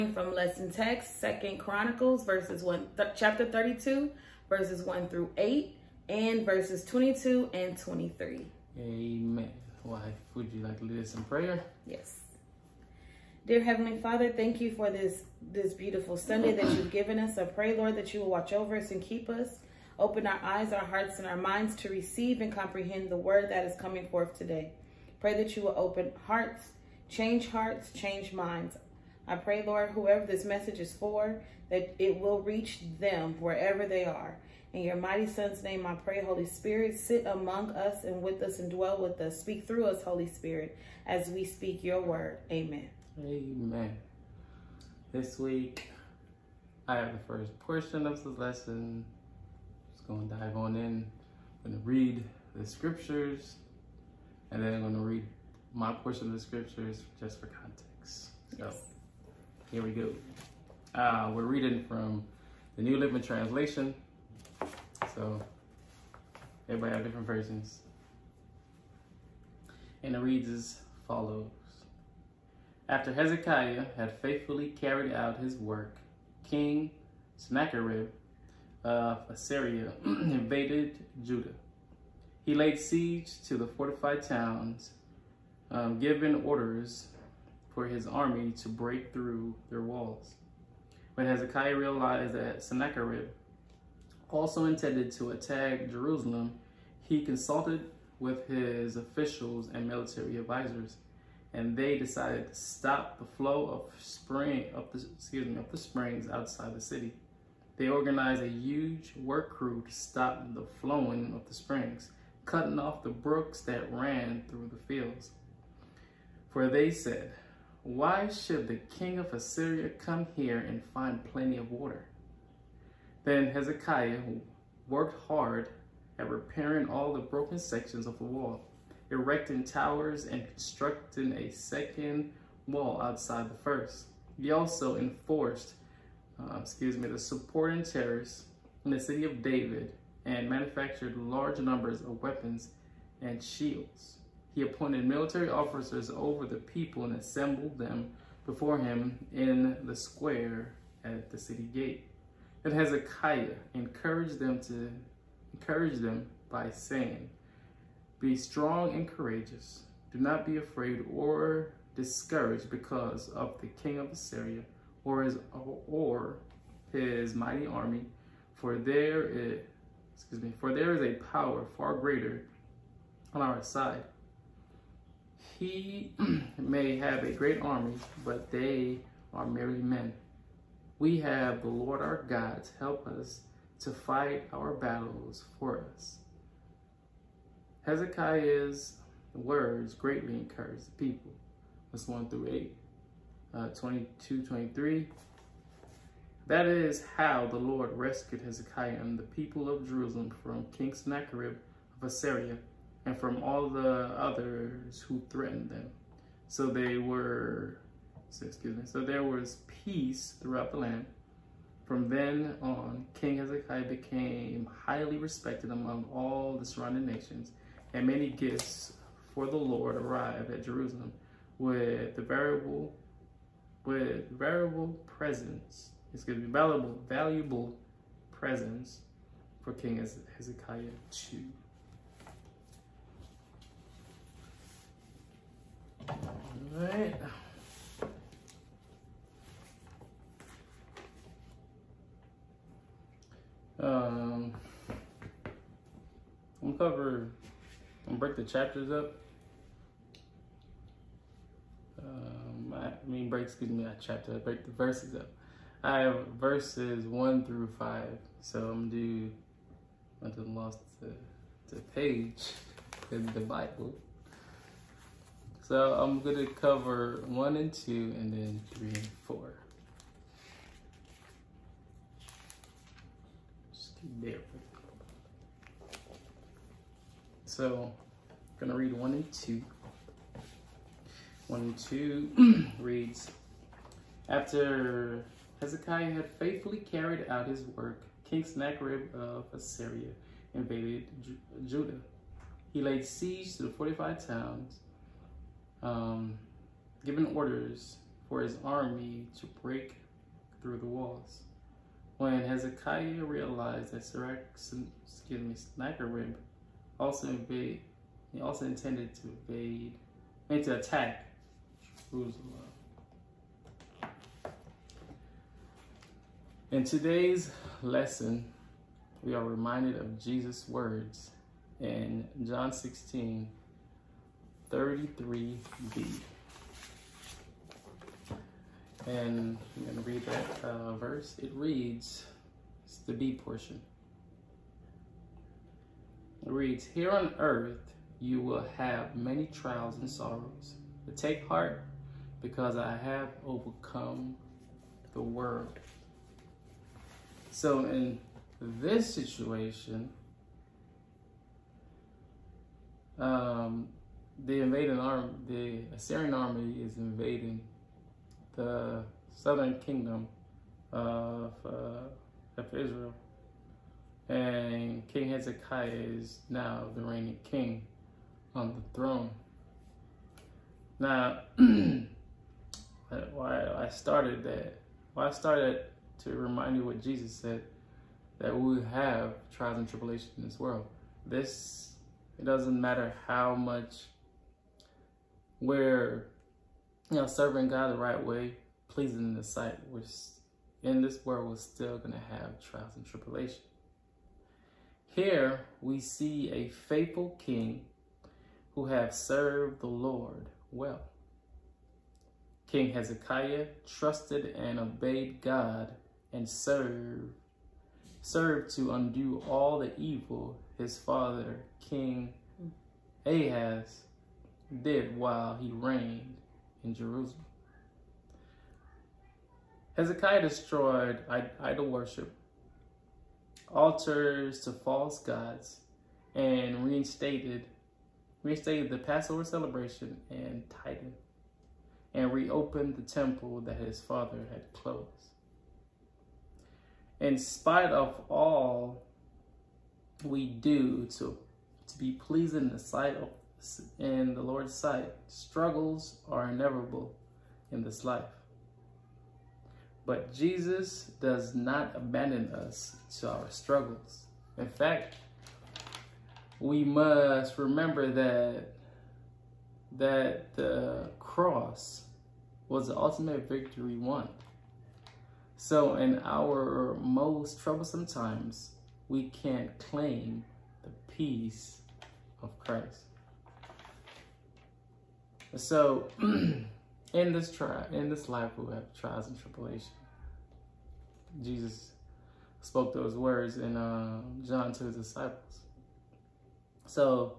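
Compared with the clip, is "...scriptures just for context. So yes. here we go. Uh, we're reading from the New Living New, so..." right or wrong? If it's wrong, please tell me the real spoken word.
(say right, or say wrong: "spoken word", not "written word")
wrong: "Translation", not "New".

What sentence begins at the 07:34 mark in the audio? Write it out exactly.
In fact, we must remember that that the cross was the ultimate victory won.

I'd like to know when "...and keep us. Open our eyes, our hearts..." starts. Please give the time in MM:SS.
00:18.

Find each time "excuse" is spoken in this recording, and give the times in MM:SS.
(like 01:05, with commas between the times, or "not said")
01:45, 02:16, 02:50, 03:28, 04:13, 05:04.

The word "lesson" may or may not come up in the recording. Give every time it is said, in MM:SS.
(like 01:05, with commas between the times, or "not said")
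00:00, 00:48, 05:17.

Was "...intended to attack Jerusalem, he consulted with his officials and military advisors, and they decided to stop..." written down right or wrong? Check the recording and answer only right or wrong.
right.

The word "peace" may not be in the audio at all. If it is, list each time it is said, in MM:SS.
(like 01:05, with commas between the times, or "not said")
03:29, 07:51.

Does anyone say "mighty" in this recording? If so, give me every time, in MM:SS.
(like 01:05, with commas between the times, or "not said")
00:34, 02:47.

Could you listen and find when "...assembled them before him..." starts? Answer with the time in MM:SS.
02:27.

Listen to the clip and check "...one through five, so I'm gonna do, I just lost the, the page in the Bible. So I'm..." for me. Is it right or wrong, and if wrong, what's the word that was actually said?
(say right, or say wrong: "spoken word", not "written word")
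right.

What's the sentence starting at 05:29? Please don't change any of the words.
And I'm going to read that uh, verse.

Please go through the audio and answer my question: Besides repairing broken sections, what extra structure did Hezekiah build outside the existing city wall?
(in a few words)
a second wall.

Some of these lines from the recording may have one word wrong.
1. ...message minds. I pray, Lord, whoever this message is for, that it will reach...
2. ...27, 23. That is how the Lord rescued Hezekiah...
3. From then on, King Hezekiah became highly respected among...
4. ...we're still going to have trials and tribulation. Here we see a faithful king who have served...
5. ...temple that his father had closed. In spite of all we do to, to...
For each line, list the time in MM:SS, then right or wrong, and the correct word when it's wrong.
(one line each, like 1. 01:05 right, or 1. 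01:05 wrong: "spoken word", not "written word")
1. 00:27 wrong: "change", not "message"
2. 03:13 wrong: "22", not "27"
3. 03:31 right
4. 06:31 right
5. 07:13 right.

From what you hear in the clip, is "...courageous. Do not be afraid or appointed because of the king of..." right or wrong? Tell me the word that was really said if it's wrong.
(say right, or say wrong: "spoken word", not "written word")
wrong: "discouraged", not "appointed".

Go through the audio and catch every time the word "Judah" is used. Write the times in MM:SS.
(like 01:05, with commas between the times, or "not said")
01:21, 04:51.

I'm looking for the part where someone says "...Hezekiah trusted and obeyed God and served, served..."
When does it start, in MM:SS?
06:42.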